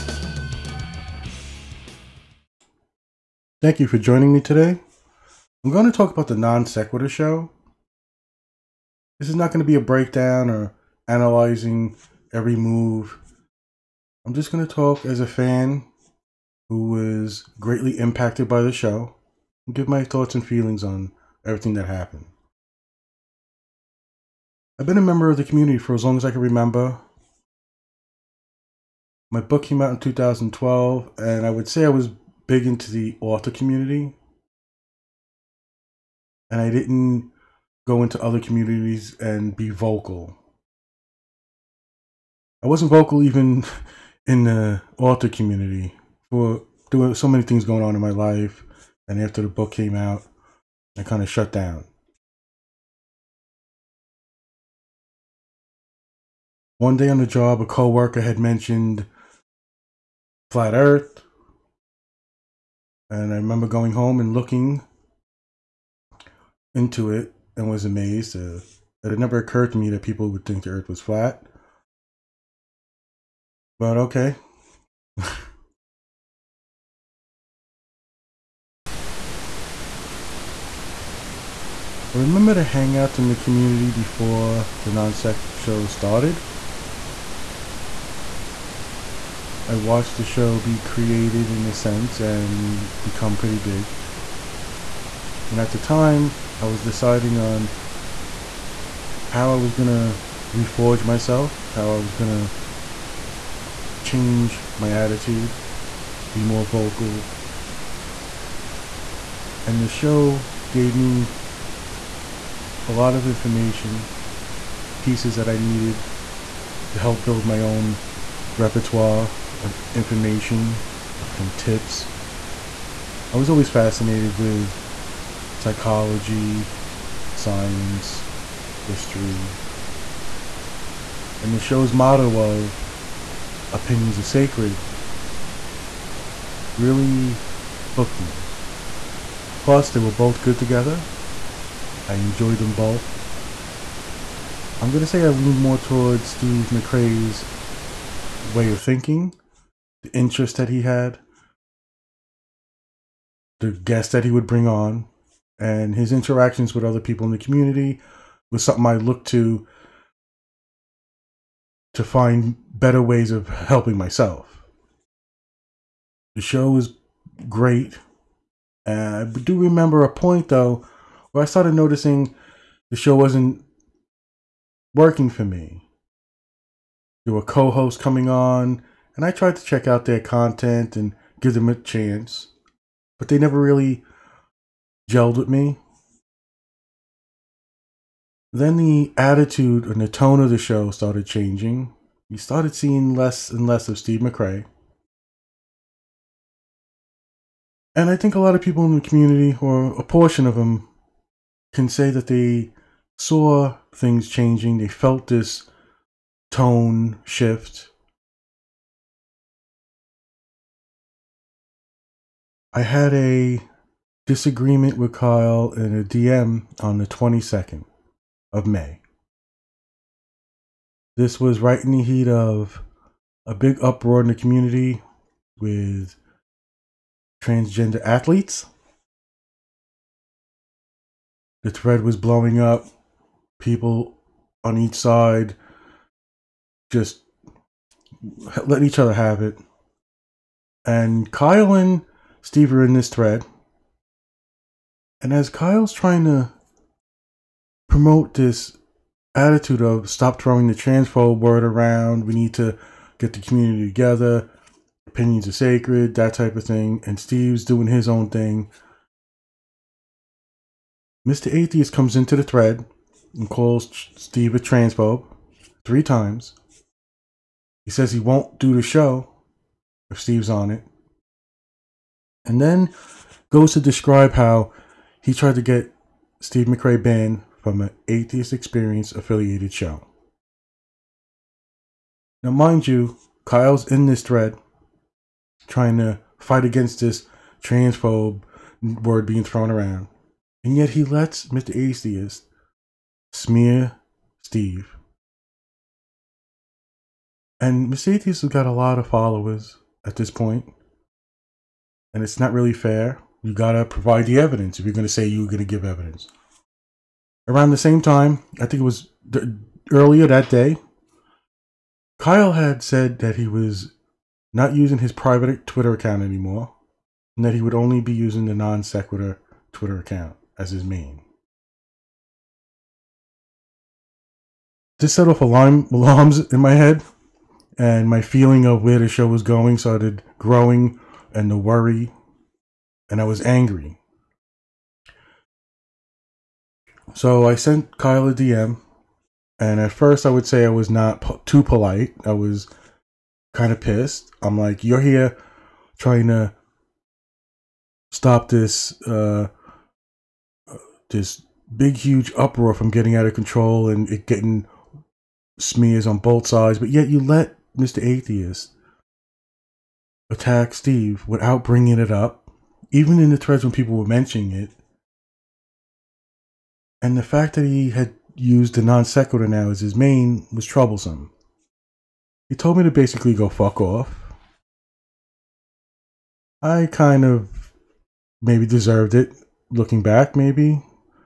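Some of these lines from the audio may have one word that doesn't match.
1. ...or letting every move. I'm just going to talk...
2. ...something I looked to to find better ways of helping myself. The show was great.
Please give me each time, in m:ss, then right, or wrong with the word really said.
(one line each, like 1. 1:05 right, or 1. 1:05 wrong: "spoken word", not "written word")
1. 0:10 wrong: "analyzing", not "letting"
2. 2:38 right.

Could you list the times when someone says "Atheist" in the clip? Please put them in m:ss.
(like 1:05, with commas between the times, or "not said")
4:21, 4:38, 4:51, 4:58, 5:58.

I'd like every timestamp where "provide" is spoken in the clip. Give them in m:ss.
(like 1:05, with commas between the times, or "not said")
5:03.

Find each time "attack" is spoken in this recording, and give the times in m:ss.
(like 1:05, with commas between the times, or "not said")
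6:00.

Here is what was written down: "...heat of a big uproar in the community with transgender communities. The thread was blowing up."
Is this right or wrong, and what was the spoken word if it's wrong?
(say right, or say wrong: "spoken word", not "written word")
wrong: "athletes", not "communities".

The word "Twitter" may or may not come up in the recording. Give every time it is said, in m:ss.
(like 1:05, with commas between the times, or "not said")
5:15, 5:19.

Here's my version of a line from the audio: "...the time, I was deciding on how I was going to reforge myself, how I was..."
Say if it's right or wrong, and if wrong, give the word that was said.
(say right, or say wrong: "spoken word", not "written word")
right.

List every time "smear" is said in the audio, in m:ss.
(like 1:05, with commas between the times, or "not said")
4:53, 5:55.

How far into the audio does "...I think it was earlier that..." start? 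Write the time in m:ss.
5:08.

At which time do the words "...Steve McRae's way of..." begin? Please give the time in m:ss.
2:26.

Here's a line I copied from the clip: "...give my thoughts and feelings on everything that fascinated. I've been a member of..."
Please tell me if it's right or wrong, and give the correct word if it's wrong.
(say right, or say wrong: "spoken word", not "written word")
wrong: "happened", not "fascinated".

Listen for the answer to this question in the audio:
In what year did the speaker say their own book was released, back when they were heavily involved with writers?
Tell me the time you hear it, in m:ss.
0:29.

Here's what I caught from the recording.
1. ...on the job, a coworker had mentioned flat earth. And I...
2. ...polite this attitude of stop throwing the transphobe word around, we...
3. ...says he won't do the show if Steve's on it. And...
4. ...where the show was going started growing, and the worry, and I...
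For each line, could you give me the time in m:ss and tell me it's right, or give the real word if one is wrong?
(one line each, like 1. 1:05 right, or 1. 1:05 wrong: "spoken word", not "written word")
1. 0:57 right
2. 4:07 wrong: "promote", not "polite"
3. 4:27 right
4. 5:28 right.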